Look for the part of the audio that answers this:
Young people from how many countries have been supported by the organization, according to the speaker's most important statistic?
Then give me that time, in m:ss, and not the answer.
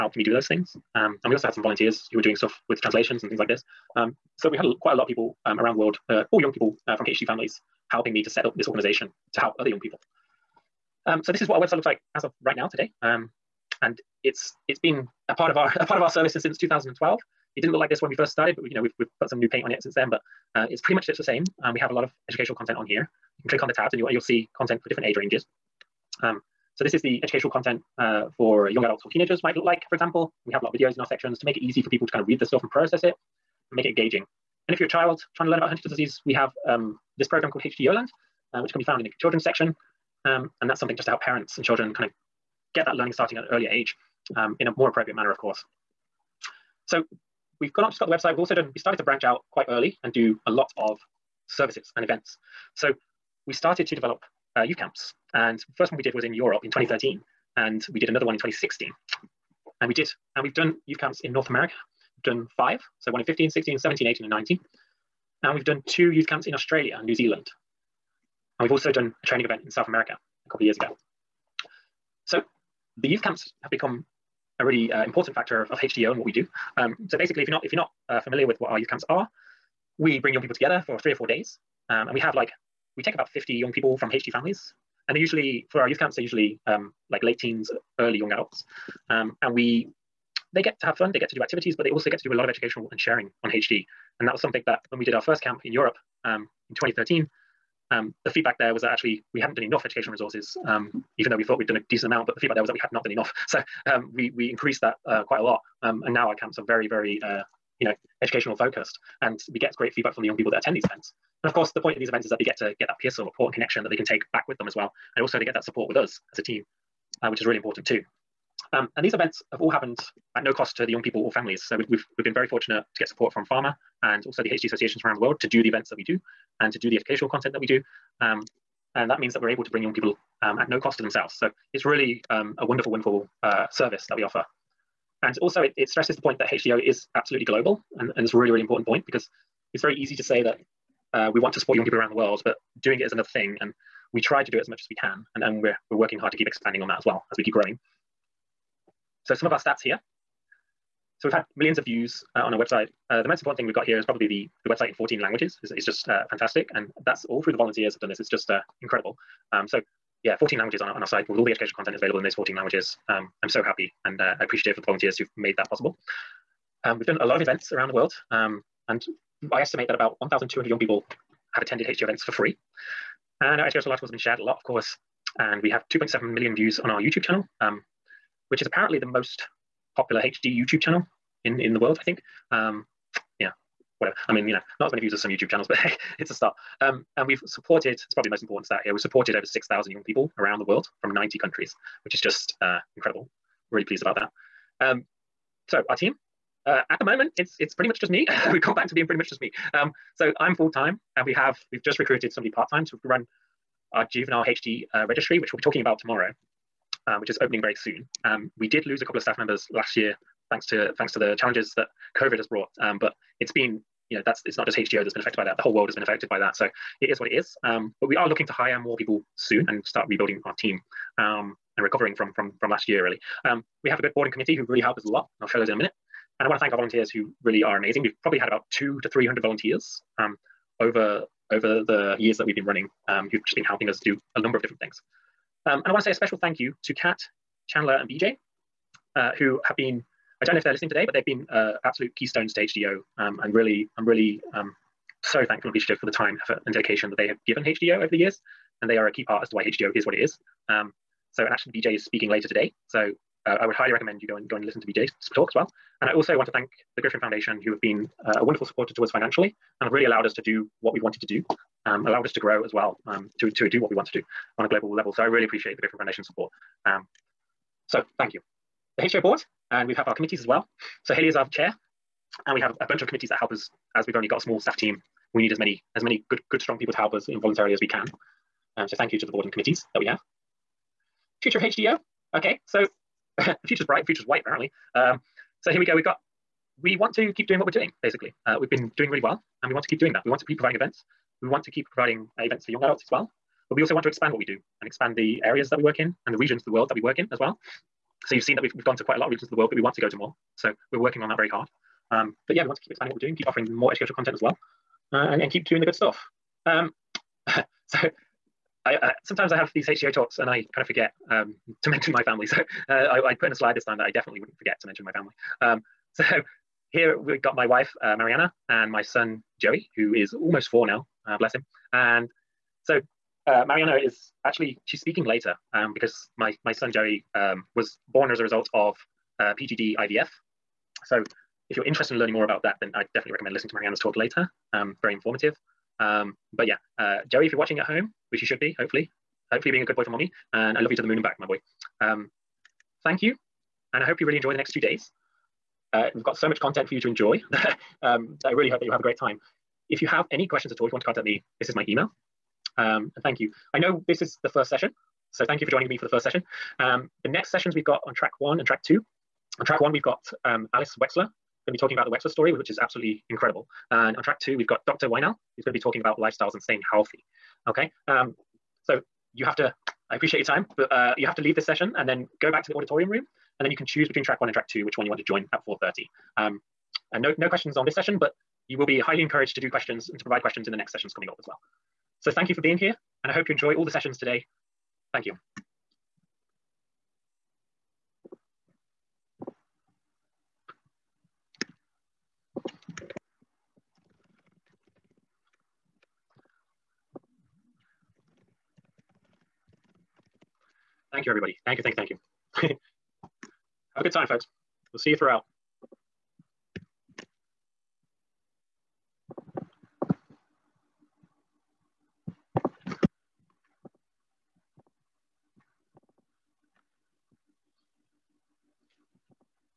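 3:11.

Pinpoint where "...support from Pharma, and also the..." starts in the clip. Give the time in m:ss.
2:03.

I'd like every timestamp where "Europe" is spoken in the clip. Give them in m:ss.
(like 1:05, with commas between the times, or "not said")
0:56, 1:35.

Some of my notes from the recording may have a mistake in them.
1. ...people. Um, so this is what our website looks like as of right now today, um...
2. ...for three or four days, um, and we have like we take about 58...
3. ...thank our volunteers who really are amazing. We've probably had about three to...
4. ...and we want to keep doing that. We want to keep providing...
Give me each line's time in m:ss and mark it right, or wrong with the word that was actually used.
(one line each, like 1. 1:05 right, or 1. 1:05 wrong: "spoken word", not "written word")
1. 0:09 right
2. 1:20 wrong: "50", not "58"
3. 3:46 wrong: "two", not "three"
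4. 4:49 right.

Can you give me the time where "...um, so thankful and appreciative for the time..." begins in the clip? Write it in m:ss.
4:04.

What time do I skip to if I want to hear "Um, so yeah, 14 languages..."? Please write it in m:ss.
2:39.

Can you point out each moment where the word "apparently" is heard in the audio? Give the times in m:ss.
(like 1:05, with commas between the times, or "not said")
2:58, 4:44.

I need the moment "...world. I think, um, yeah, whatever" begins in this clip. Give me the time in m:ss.
3:01.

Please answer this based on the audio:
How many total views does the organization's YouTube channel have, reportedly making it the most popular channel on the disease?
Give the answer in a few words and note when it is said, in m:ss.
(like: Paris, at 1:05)
2.7 million, at 2:55.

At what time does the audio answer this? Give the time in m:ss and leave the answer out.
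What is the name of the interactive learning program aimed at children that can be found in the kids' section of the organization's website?
0:37.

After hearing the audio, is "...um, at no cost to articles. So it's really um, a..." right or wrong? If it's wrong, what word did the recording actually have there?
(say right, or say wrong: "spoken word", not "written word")
wrong: "themselves", not "articles".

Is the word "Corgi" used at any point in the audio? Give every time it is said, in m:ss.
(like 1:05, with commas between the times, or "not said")
not said.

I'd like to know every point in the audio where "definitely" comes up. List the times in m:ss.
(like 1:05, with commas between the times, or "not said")
5:14, 5:33.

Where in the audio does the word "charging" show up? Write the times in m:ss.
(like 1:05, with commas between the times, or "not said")
not said.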